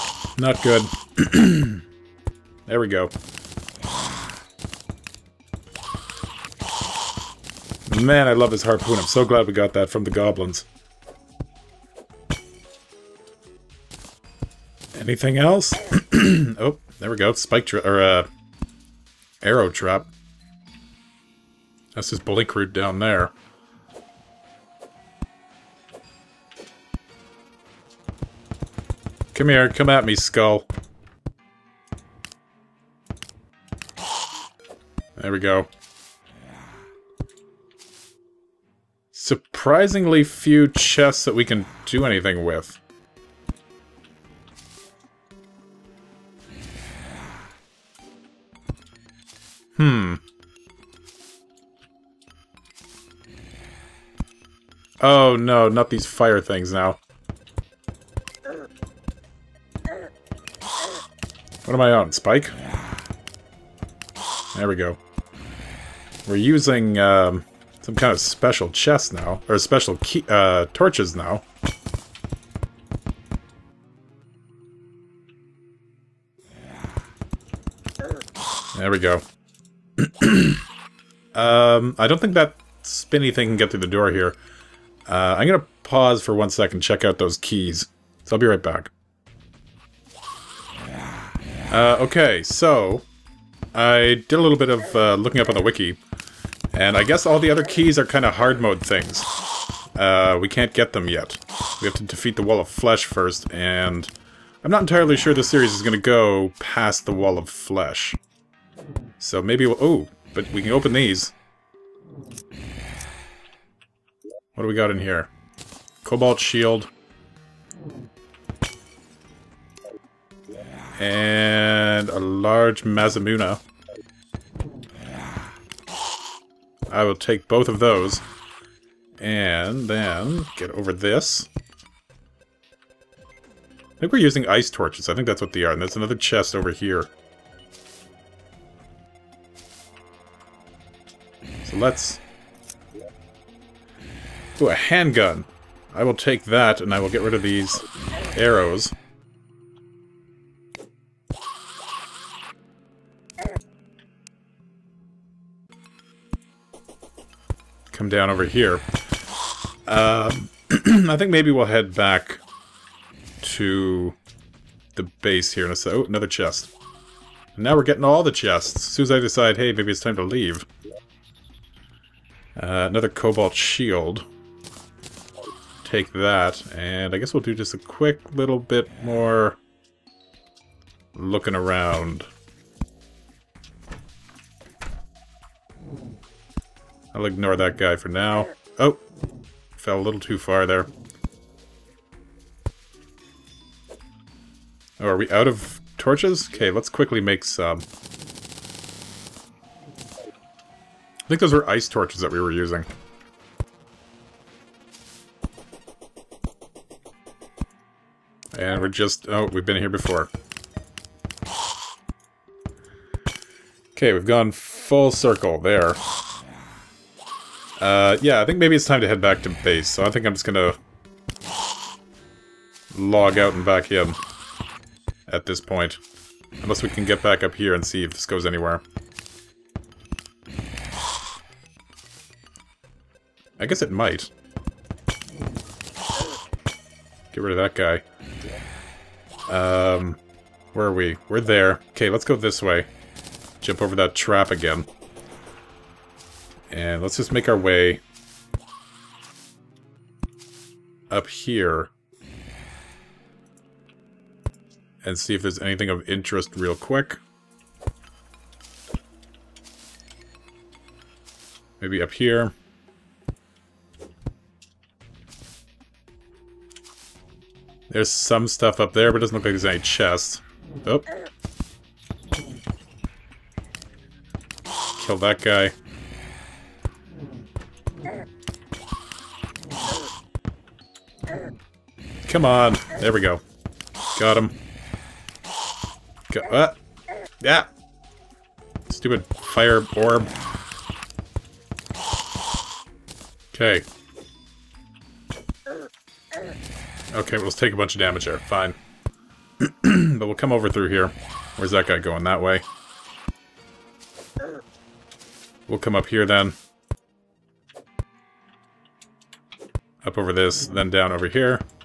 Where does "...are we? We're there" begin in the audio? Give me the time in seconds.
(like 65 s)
240 s.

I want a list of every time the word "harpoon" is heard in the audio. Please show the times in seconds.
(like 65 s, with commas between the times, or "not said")
8 s.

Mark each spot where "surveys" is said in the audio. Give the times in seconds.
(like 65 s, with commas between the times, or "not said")
not said.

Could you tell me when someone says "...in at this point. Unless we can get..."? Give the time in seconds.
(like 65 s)
223 s.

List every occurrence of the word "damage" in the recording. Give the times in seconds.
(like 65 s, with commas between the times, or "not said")
298 s.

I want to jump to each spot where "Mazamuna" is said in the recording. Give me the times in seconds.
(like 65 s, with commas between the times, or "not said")
122 s.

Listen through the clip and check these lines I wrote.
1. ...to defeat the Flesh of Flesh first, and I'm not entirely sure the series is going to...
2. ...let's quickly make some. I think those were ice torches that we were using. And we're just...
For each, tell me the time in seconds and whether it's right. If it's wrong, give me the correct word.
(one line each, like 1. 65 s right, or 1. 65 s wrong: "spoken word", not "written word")
1. 101 s wrong: "Wall", not "Flesh"
2. 196 s right.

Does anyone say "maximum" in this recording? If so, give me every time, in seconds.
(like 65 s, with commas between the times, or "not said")
not said.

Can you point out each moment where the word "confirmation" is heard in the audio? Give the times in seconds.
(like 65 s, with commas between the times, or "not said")
not said.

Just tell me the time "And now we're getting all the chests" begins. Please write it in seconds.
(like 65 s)
167 s.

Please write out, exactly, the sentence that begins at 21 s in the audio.
That's his blink root down there.